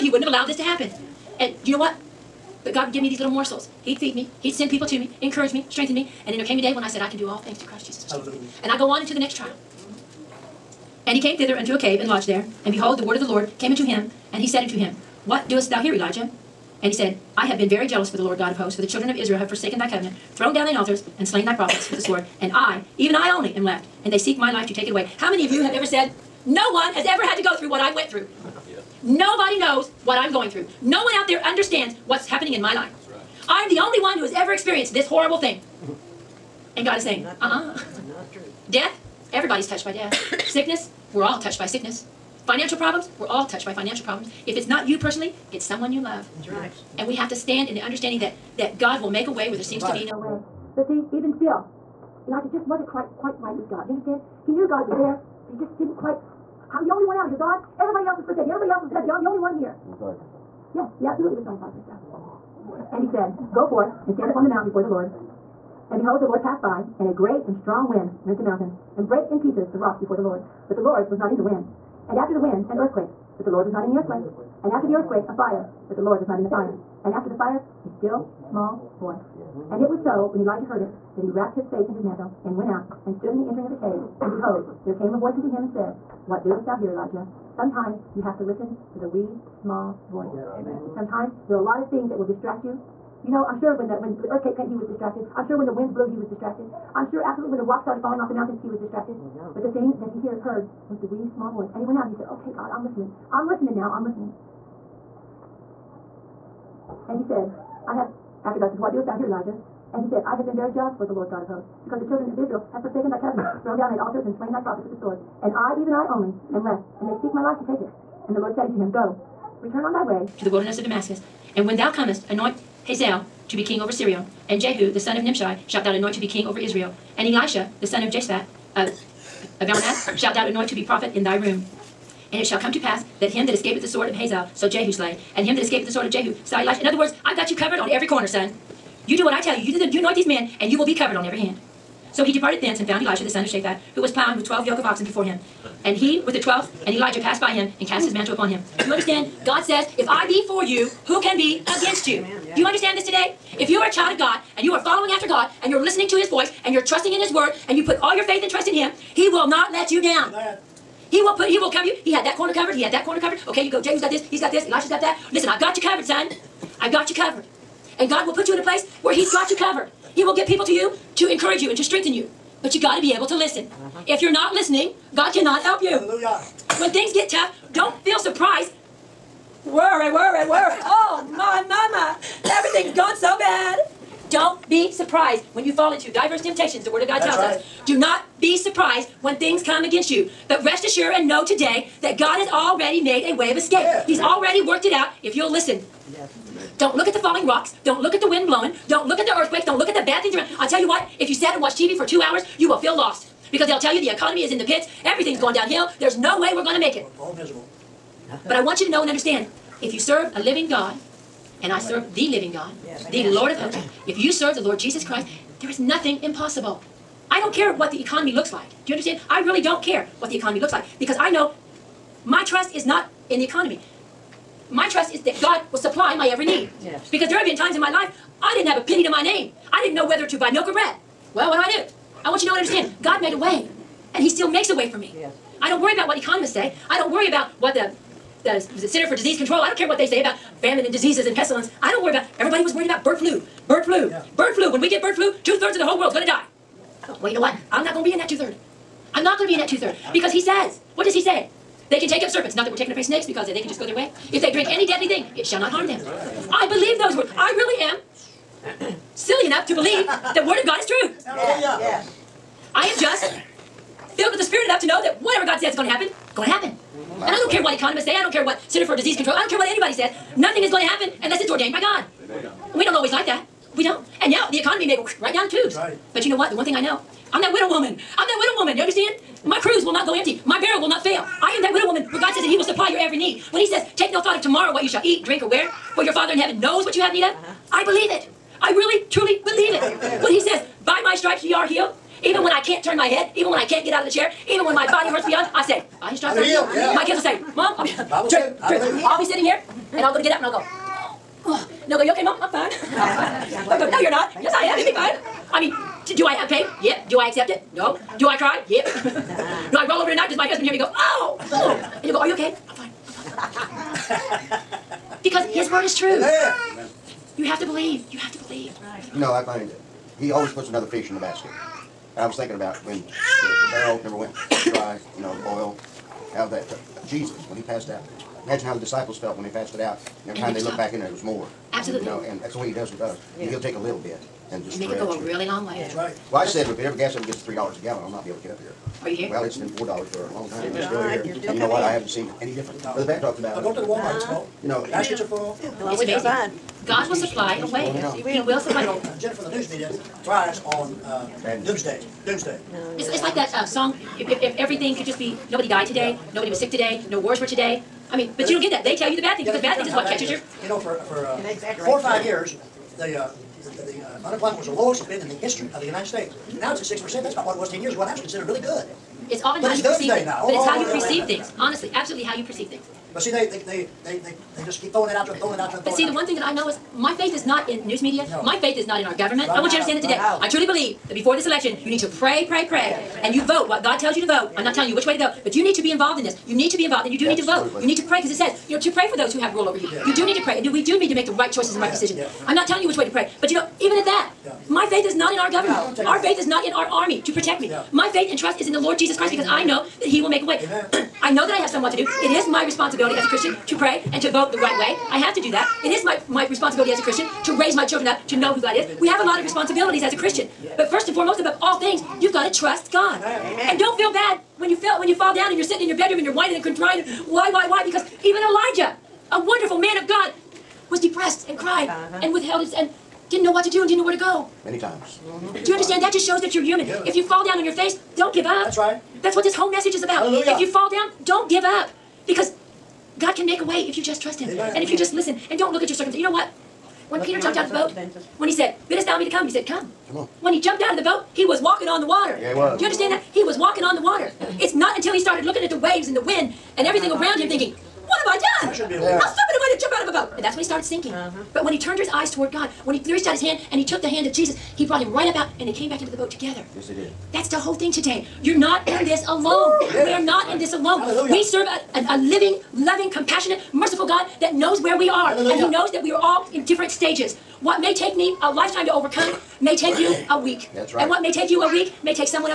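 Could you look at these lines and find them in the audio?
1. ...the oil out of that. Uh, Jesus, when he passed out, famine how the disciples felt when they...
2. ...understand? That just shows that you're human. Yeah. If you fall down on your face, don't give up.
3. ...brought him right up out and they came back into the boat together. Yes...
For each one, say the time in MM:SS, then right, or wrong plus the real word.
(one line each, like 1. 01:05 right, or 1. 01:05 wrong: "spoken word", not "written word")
1. 05:25 wrong: "imagine", not "famine"
2. 07:05 right
3. 07:34 right.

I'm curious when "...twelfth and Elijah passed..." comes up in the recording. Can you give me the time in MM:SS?
02:26.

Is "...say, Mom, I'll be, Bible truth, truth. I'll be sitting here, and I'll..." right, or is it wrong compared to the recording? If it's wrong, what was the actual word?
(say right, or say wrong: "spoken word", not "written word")
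right.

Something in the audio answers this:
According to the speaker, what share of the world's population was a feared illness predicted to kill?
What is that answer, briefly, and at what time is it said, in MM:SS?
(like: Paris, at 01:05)
Two-thirds, at 04:05.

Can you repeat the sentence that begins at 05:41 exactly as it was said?
You're still And you know what, I haven't seen any different.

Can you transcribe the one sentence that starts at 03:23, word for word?
Because they'll tell you the economy is in the pits.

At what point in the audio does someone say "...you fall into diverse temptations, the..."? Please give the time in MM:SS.
03:05.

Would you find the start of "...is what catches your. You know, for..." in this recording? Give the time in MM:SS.
05:59.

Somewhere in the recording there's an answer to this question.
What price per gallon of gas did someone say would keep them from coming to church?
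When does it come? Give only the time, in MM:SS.
05:37.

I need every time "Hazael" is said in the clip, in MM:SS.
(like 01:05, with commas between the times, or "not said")
02:02, 02:14.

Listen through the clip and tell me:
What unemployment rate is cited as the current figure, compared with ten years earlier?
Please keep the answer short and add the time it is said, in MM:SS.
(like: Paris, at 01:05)
6%, at 06:06.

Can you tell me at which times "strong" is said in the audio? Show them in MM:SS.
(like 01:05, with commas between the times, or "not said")
01:07.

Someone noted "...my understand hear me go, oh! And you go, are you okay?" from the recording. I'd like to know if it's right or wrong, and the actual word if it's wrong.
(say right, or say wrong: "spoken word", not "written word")
wrong: "husband", not "understand".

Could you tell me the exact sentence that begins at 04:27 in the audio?
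And I don't care what economists say.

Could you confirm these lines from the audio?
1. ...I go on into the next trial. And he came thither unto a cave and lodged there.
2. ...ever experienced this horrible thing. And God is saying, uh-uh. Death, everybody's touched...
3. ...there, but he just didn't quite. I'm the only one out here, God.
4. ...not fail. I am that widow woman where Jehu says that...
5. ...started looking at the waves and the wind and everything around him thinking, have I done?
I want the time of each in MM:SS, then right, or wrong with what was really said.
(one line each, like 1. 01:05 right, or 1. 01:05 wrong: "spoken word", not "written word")
1. 00:08 right
2. 00:34 right
3. 00:54 right
4. 04:40 wrong: "God", not "Jehu"
5. 07:25 right.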